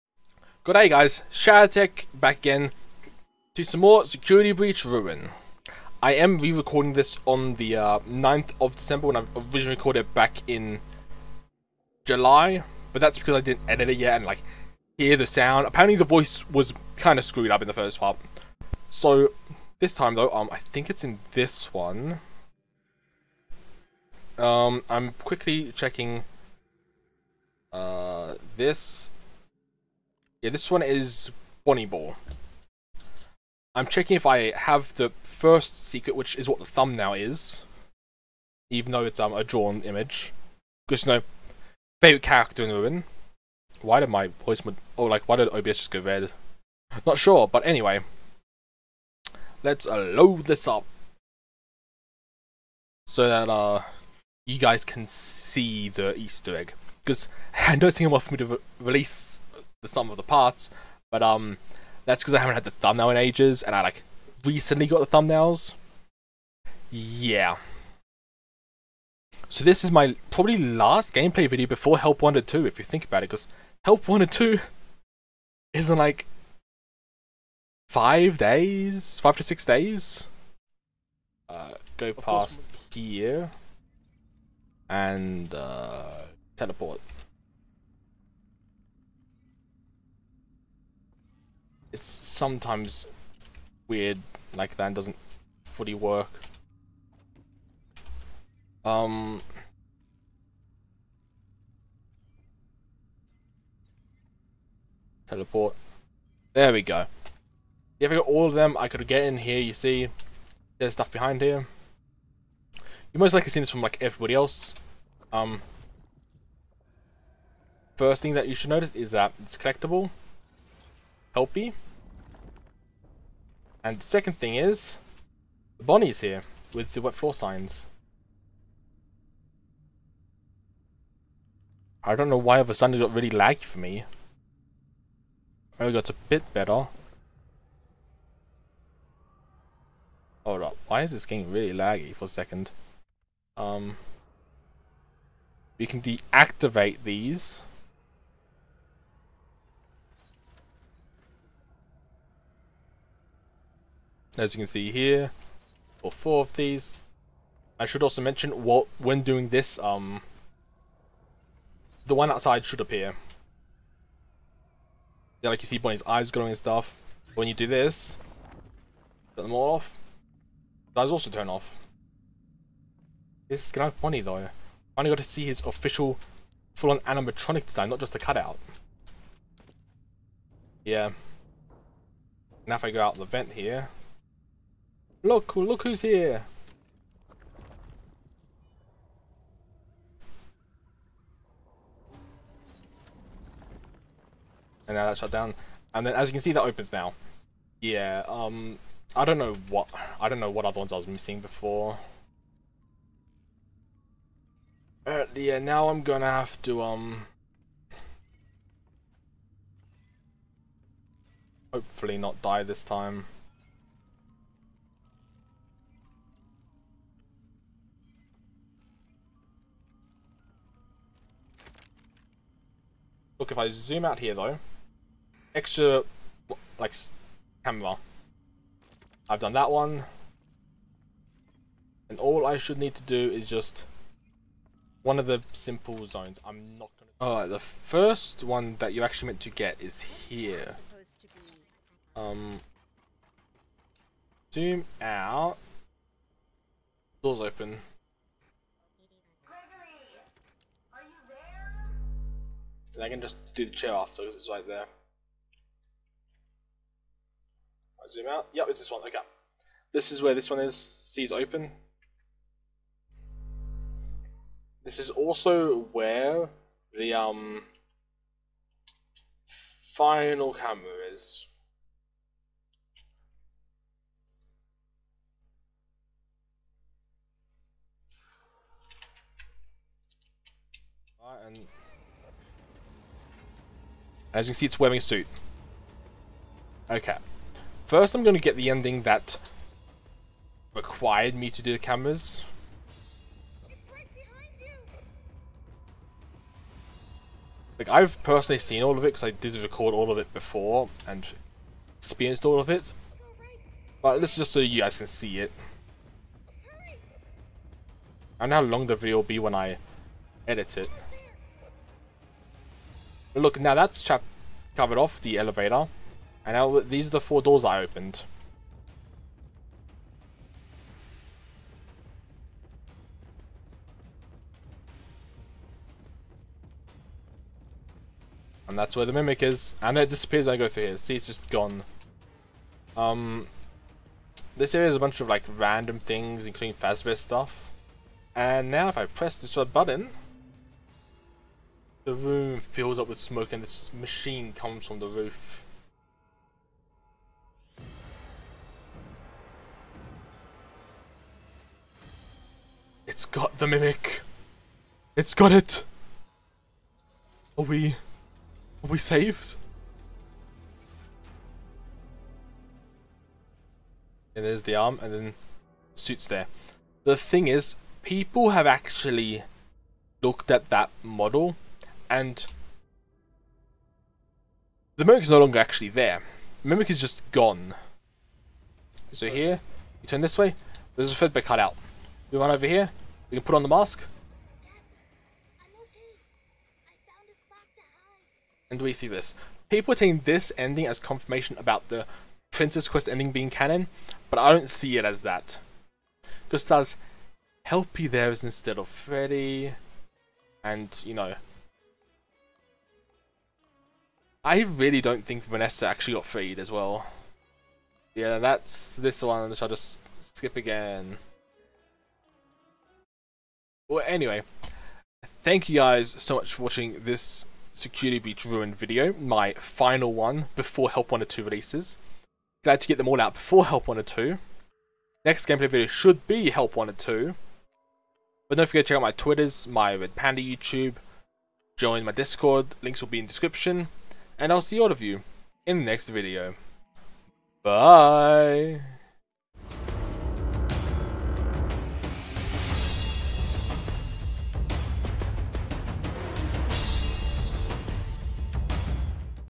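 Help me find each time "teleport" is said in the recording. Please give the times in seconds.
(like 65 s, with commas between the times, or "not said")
86 s, 105 s.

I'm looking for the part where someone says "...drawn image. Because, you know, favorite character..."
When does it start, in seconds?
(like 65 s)
39 s.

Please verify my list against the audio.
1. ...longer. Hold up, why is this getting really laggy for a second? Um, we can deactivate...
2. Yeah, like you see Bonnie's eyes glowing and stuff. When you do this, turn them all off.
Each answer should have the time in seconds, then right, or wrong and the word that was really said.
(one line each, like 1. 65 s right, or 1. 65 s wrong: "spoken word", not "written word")
1. 136 s wrong: "better", not "longer"
2. 165 s right.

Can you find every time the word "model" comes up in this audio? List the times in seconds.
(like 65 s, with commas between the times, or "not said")
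371 s.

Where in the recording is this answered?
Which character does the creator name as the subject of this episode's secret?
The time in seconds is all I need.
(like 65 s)
31 s.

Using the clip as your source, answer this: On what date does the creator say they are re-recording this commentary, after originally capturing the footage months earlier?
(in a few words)
9th of December.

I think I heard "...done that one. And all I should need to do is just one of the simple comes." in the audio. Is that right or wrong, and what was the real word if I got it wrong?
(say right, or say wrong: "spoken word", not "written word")
wrong: "zones", not "comes".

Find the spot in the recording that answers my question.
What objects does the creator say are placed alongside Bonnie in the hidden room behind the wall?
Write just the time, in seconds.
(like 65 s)
127 s.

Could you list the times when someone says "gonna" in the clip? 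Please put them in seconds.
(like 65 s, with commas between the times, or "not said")
173 s, 206 s.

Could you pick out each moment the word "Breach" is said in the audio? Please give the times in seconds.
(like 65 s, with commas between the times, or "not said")
4 s, 418 s.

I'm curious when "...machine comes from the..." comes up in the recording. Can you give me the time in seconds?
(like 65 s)
343 s.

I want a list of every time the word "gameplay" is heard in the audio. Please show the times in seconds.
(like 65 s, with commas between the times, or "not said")
71 s, 425 s.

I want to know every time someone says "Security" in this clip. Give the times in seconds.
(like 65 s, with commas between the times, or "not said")
4 s, 417 s.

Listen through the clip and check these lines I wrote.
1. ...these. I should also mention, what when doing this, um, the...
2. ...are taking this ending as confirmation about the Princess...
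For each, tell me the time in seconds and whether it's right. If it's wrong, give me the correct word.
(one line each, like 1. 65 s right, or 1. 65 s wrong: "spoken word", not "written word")
1. 156 s right
2. 389 s right.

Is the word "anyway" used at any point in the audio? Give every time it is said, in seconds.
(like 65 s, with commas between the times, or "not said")
47 s, 414 s.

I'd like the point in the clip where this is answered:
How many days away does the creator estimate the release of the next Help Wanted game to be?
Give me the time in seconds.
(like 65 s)
79 s.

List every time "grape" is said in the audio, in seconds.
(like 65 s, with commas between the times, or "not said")
not said.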